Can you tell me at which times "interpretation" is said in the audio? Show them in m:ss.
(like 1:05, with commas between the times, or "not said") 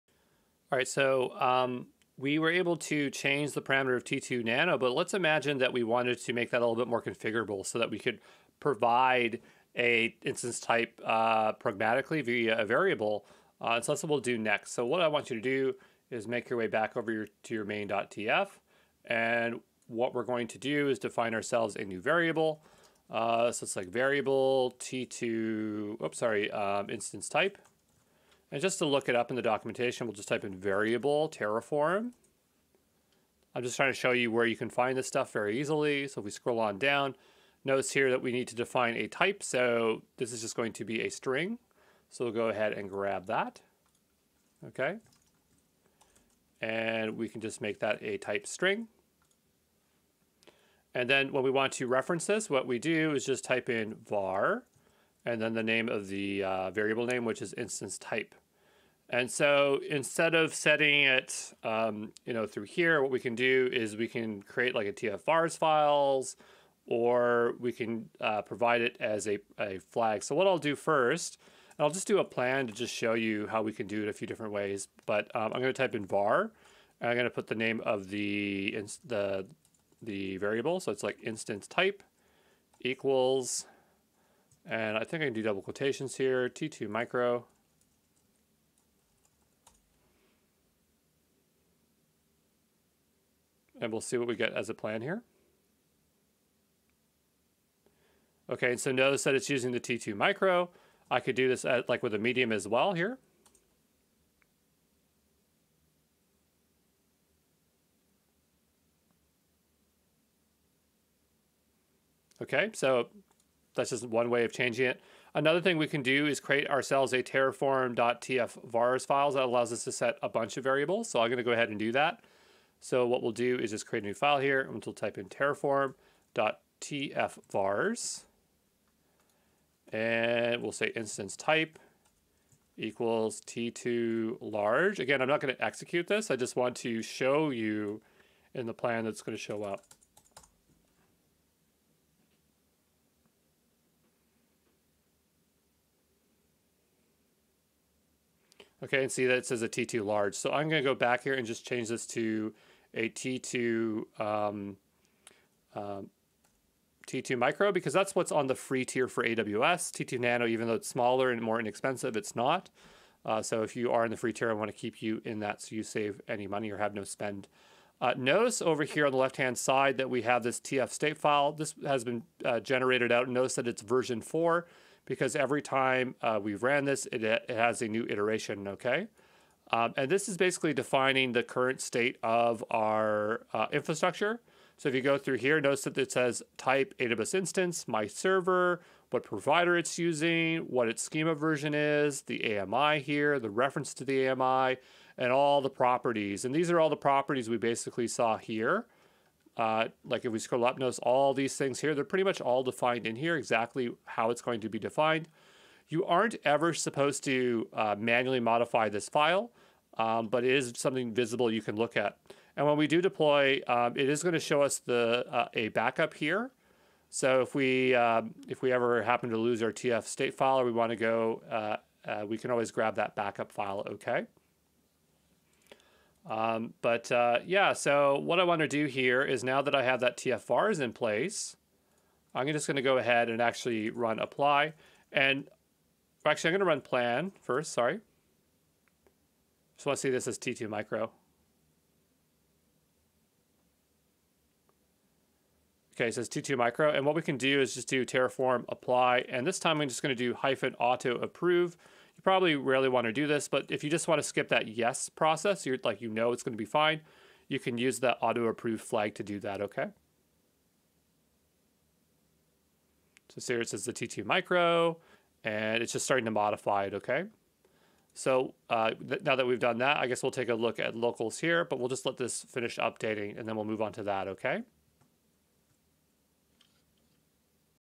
not said.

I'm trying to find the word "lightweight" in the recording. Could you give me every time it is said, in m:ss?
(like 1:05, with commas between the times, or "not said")
not said.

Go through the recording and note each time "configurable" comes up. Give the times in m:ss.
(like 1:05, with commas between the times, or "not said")
0:07.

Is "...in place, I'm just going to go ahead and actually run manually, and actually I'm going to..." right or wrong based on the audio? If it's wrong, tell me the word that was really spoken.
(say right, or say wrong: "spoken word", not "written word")
wrong: "apply", not "manually".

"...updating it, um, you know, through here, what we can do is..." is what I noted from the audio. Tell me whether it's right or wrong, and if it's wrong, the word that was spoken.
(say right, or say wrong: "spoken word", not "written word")
wrong: "setting", not "updating".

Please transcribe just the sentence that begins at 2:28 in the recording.
Okay, and see that it says a T2 large.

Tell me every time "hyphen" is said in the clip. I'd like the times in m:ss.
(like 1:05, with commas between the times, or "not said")
4:10.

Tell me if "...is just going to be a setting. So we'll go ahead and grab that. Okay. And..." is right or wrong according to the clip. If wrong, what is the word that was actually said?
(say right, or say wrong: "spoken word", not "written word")
wrong: "string", not "setting".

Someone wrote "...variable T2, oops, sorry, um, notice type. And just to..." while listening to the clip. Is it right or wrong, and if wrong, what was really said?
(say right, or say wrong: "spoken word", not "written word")
wrong: "instance", not "notice".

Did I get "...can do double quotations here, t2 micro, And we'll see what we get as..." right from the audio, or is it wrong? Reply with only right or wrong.
right.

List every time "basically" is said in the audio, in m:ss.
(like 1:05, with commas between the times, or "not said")
3:00, 3:17.